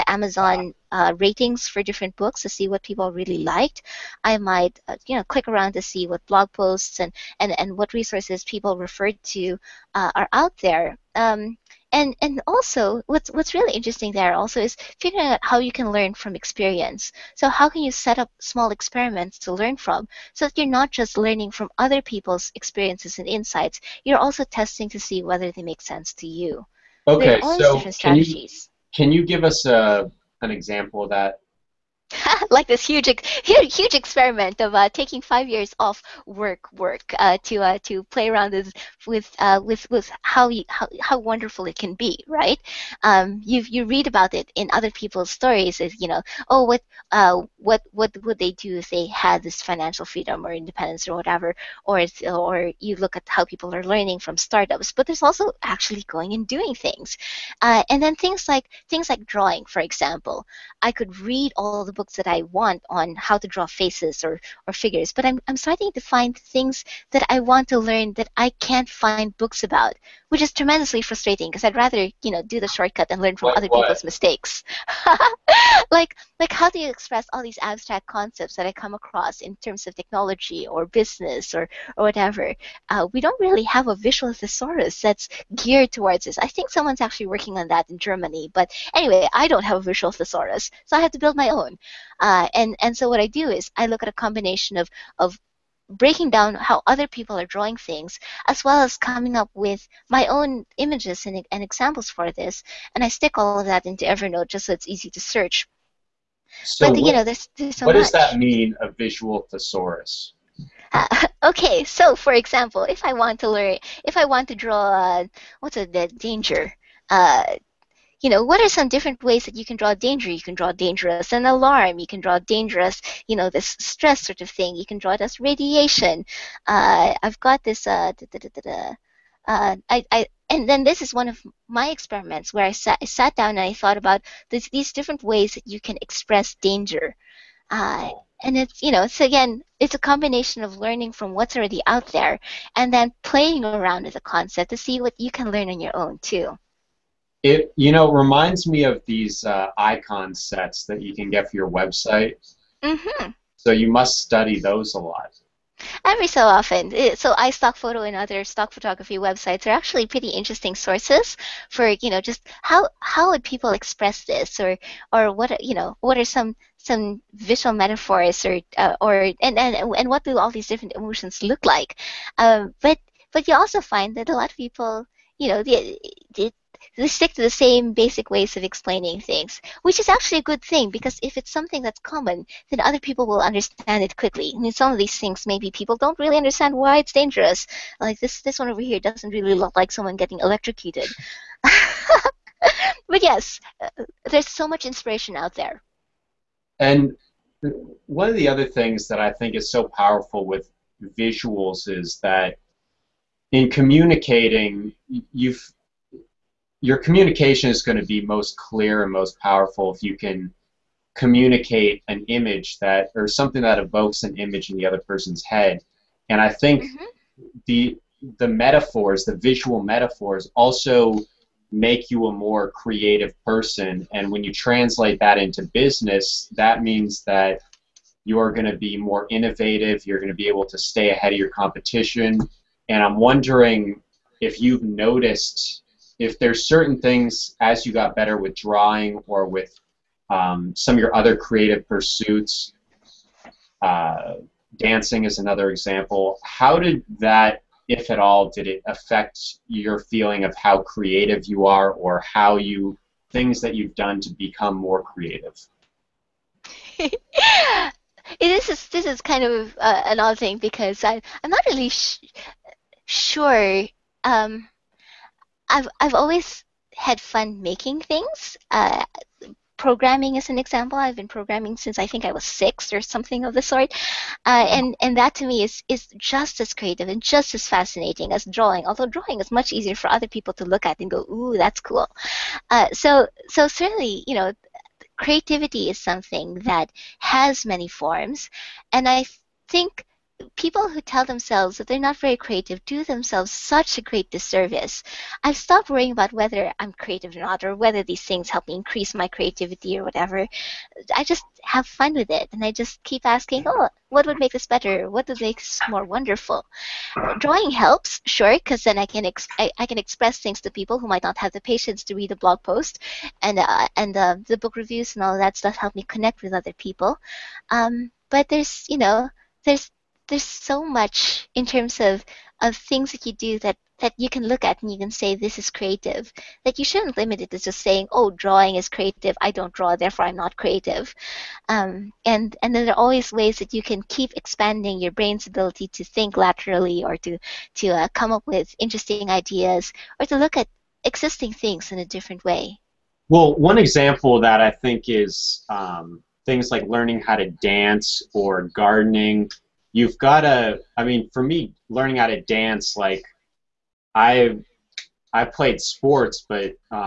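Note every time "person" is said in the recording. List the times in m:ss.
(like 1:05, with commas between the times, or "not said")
3:34, 3:43.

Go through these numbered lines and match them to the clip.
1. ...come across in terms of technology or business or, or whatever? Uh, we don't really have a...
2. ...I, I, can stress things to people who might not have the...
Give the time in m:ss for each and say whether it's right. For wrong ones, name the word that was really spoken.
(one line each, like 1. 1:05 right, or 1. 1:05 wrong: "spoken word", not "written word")
1. 1:18 right
2. 5:09 wrong: "express", not "stress".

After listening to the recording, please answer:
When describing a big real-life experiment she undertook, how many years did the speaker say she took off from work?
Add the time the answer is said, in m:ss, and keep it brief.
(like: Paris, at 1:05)
5, at 0:35.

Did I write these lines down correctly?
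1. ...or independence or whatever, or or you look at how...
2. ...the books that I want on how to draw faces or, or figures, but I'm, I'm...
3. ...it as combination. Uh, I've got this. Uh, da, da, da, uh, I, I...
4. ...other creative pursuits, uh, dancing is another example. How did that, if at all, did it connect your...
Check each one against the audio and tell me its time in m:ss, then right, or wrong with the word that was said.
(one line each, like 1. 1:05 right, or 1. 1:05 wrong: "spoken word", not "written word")
1. 0:50 right
2. 1:01 right
3. 2:05 wrong: "radiation", not "combination"
4. 4:01 wrong: "affect", not "connect".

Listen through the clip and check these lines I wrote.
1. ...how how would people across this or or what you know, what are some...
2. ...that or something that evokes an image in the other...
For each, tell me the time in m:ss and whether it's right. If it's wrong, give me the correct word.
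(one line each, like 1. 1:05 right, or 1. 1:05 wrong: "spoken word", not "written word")
1. 2:42 wrong: "express", not "across"
2. 3:32 right.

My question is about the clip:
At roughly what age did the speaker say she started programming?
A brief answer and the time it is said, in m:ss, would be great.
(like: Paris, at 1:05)
6, at 4:32.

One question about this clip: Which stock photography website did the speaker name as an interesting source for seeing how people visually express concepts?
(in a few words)
iStock Photo.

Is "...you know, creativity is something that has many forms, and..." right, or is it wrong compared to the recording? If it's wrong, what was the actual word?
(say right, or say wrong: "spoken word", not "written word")
right.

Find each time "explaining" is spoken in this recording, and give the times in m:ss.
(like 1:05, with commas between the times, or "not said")
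2:58.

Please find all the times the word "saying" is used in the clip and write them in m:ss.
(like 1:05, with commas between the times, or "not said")
5:27.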